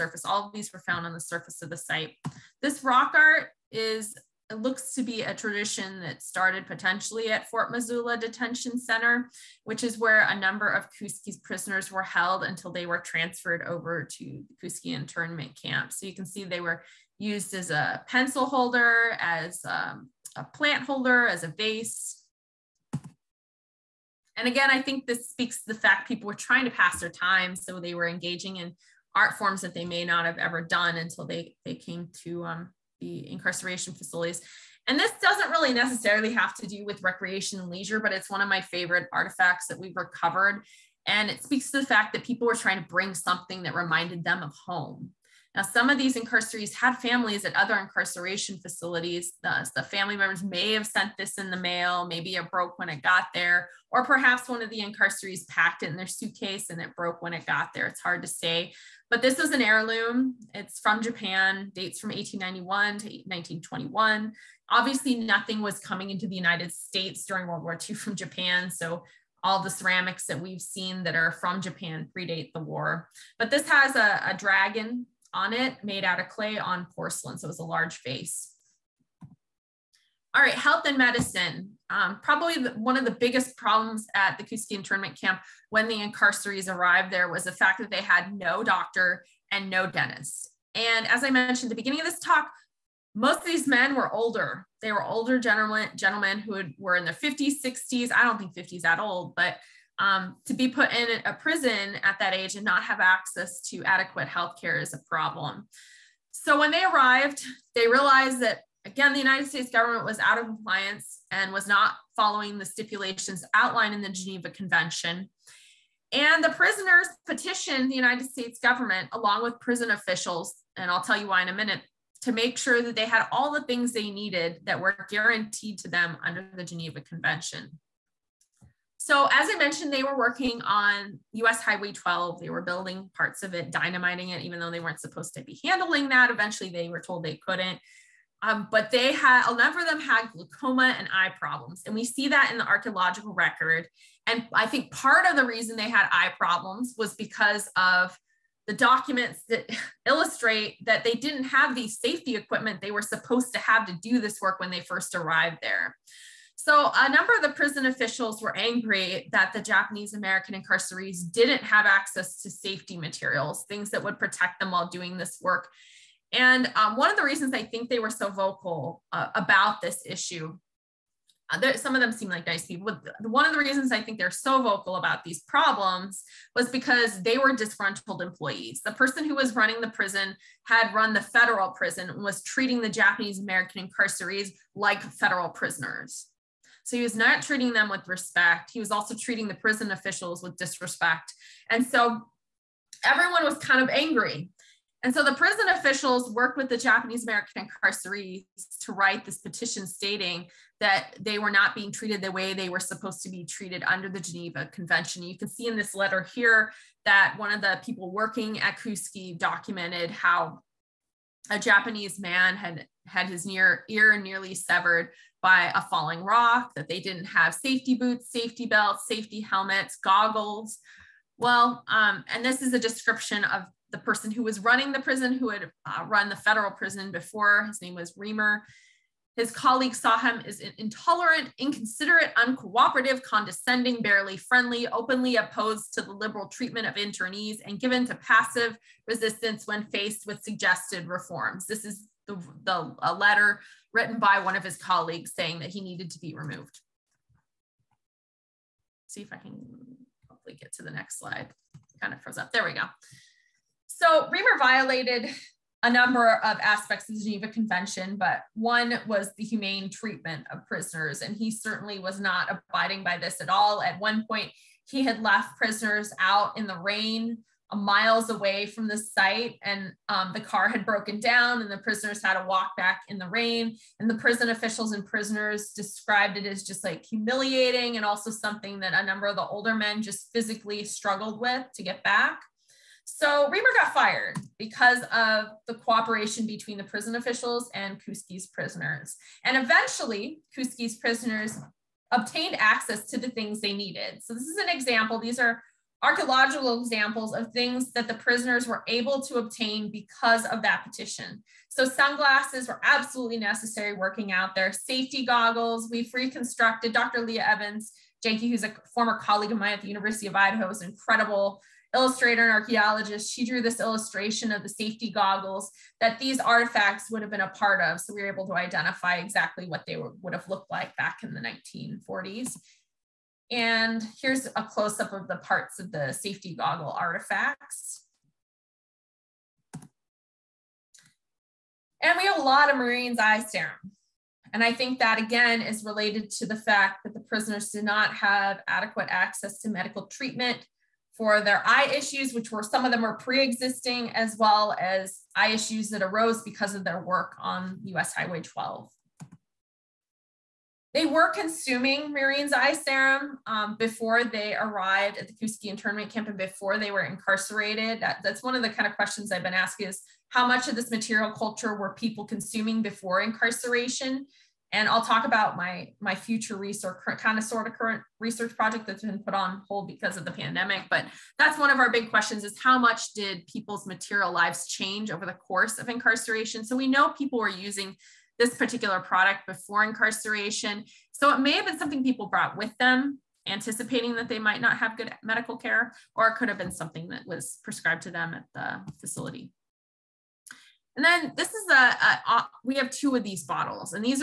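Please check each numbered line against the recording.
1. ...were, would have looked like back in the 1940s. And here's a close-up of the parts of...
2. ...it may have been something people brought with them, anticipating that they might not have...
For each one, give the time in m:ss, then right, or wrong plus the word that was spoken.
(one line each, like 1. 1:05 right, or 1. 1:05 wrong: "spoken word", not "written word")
1. 5:19 right
2. 6:21 right.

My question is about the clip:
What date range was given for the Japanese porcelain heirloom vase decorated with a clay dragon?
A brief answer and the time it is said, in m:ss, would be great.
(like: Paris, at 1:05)
1891 to 1921, at 1:02.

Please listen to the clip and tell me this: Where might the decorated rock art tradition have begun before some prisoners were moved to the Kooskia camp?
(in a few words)
Fort Missoula Detention Center.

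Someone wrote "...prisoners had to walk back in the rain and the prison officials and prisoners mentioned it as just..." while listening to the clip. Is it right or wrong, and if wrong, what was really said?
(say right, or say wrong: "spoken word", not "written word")
wrong: "described", not "mentioned".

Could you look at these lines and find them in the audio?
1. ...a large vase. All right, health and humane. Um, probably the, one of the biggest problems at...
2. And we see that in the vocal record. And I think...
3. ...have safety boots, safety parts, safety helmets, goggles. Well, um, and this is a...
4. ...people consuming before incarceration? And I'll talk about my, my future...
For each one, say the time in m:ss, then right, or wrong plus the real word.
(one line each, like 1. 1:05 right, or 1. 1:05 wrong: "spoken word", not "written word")
1. 1:17 wrong: "medicine", not "humane"
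2. 2:21 wrong: "archaeological", not "vocal"
3. 3:37 wrong: "belts", not "parts"
4. 6:01 right.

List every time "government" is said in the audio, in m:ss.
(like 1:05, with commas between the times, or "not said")
1:49, 1:58.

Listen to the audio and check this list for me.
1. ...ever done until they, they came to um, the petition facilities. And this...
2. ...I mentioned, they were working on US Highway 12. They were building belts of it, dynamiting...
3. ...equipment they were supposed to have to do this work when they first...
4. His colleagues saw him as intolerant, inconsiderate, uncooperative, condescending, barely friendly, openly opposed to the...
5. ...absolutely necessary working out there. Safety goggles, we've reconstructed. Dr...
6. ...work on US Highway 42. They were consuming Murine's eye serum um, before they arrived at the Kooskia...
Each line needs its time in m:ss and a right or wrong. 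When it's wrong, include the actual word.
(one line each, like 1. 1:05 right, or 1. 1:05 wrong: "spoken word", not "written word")
1. 0:30 wrong: "incarceration", not "petition"
2. 2:09 wrong: "parts", not "belts"
3. 2:32 right
4. 3:49 right
5. 5:02 right
6. 5:47 wrong: "12", not "42".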